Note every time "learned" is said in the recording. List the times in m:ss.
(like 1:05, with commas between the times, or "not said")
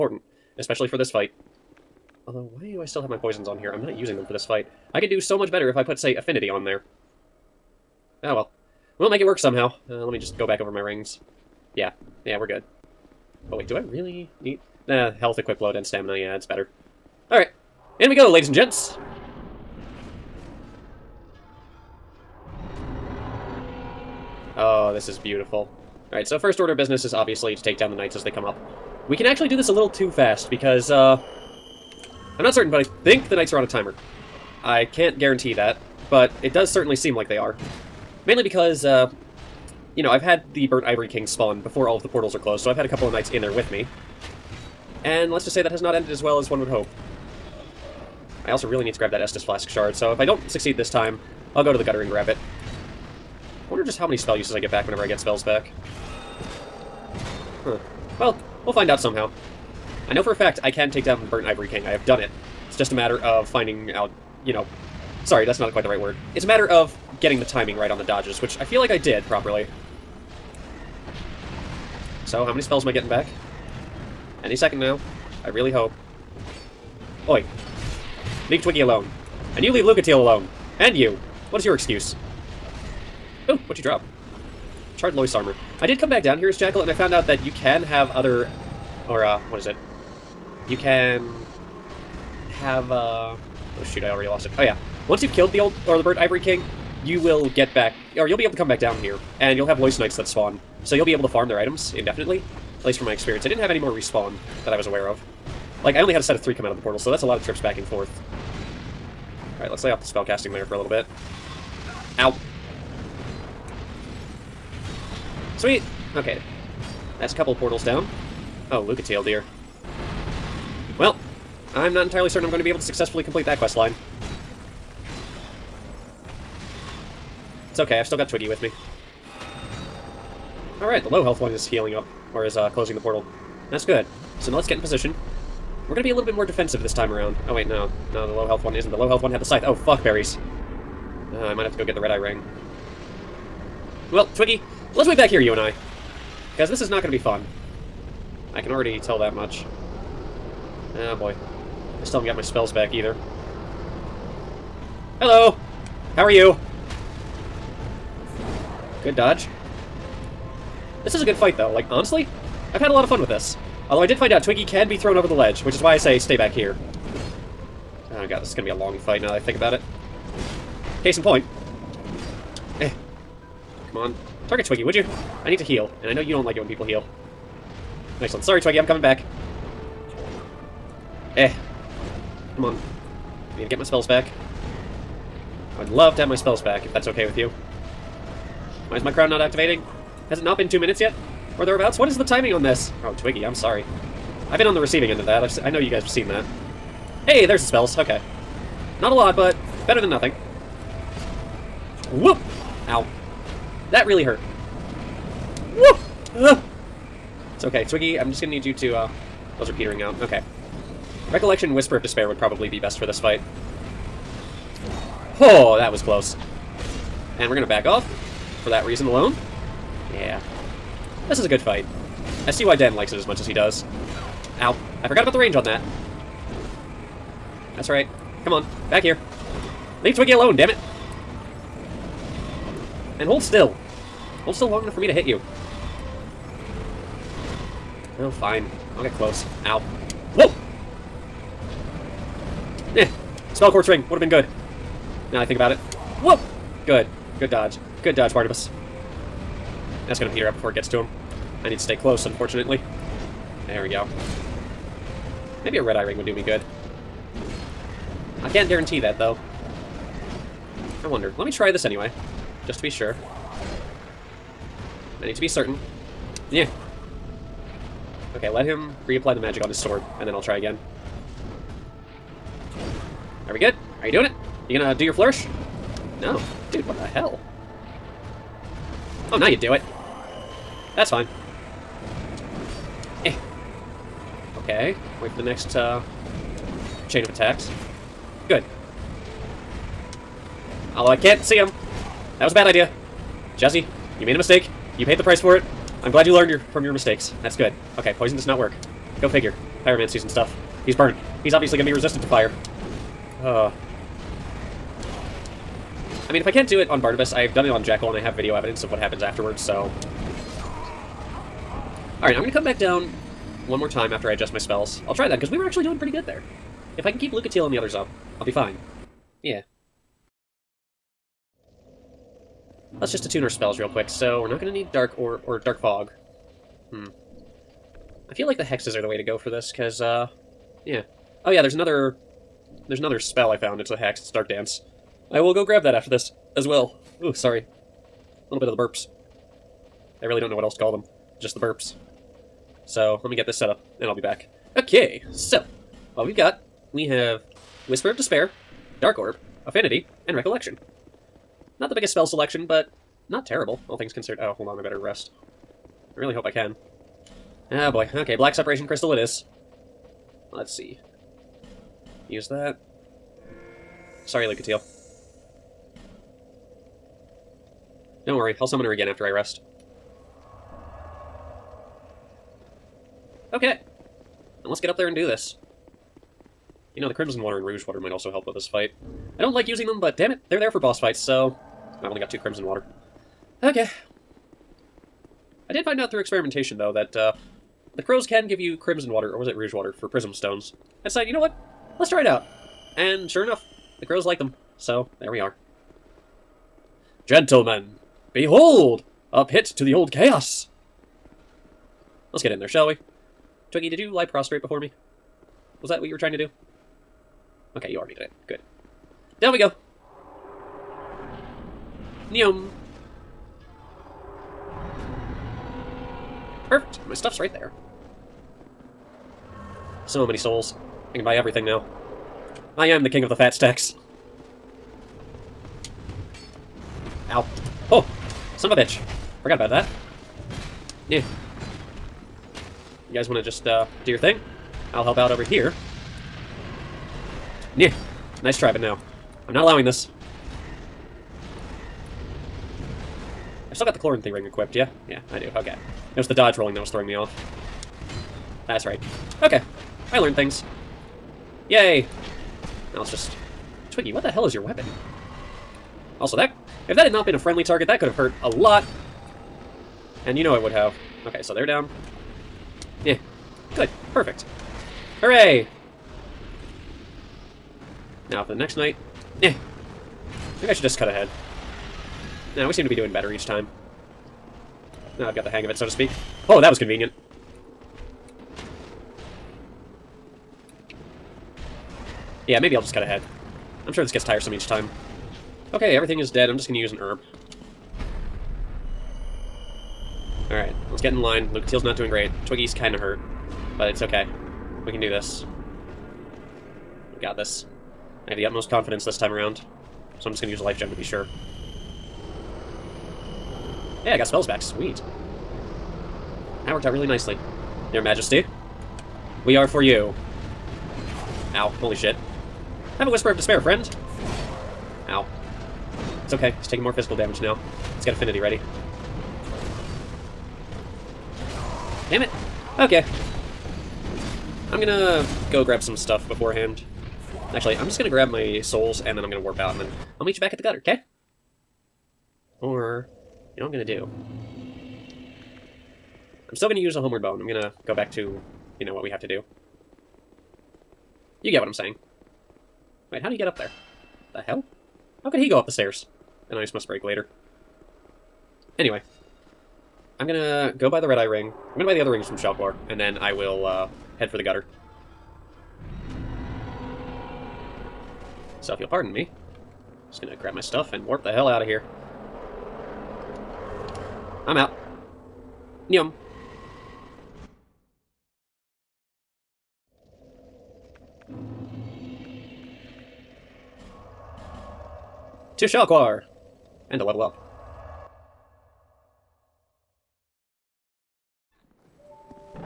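4:56, 7:30.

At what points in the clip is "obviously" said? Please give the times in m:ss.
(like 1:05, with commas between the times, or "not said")
0:27, 5:01.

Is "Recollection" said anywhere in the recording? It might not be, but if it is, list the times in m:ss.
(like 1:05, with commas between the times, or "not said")
3:31, 5:50.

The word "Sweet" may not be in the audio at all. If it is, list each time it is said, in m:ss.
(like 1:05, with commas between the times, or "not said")
1:55, 8:24.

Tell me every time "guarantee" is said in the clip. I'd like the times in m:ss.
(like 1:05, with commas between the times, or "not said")
0:35, 4:18.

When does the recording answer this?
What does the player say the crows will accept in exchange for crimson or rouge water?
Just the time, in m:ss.
6:30.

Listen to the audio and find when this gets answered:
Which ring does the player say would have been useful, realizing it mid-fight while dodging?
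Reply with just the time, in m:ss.
4:03.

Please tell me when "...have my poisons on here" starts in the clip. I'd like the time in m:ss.
0:03.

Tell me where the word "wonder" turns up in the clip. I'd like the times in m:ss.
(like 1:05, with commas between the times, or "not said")
0:53, 4:21.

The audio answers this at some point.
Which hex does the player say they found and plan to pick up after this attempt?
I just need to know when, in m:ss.
5:34.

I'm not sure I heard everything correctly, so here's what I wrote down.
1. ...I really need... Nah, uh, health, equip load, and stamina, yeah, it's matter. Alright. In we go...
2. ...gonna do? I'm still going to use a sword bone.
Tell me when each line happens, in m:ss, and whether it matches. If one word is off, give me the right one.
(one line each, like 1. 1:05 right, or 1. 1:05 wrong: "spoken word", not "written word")
1. 0:13 wrong: "better", not "matter"
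2. 8:53 wrong: "homeward", not "sword".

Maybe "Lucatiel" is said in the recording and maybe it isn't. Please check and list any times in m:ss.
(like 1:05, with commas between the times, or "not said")
1:19, 1:58, 5:17, 6:04, 8:11.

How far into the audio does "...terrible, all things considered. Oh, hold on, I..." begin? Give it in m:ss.
5:53.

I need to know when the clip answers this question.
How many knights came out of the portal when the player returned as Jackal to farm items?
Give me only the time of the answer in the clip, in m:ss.
1:46.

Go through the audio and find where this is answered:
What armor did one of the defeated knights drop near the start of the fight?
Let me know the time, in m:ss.
1:24.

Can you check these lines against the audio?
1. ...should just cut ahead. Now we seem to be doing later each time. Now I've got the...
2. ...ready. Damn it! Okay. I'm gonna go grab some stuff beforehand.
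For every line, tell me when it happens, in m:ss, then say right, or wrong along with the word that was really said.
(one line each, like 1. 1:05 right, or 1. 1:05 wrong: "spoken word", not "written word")
1. 7:50 wrong: "better", not "later"
2. 8:38 right.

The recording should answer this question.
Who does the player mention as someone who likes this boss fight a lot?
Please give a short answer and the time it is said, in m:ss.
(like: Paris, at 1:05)
Dan, at 3:42.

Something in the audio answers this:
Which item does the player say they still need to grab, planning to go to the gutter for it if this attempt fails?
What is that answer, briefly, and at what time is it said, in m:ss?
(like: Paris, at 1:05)
Estus Flask shard, at 0:49.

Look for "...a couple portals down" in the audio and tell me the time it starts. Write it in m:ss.
1:57.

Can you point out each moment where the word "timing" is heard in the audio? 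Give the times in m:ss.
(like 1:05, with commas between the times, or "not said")
1:07, 3:12.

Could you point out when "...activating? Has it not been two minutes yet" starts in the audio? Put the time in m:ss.
3:09.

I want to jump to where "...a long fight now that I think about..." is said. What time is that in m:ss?
2:48.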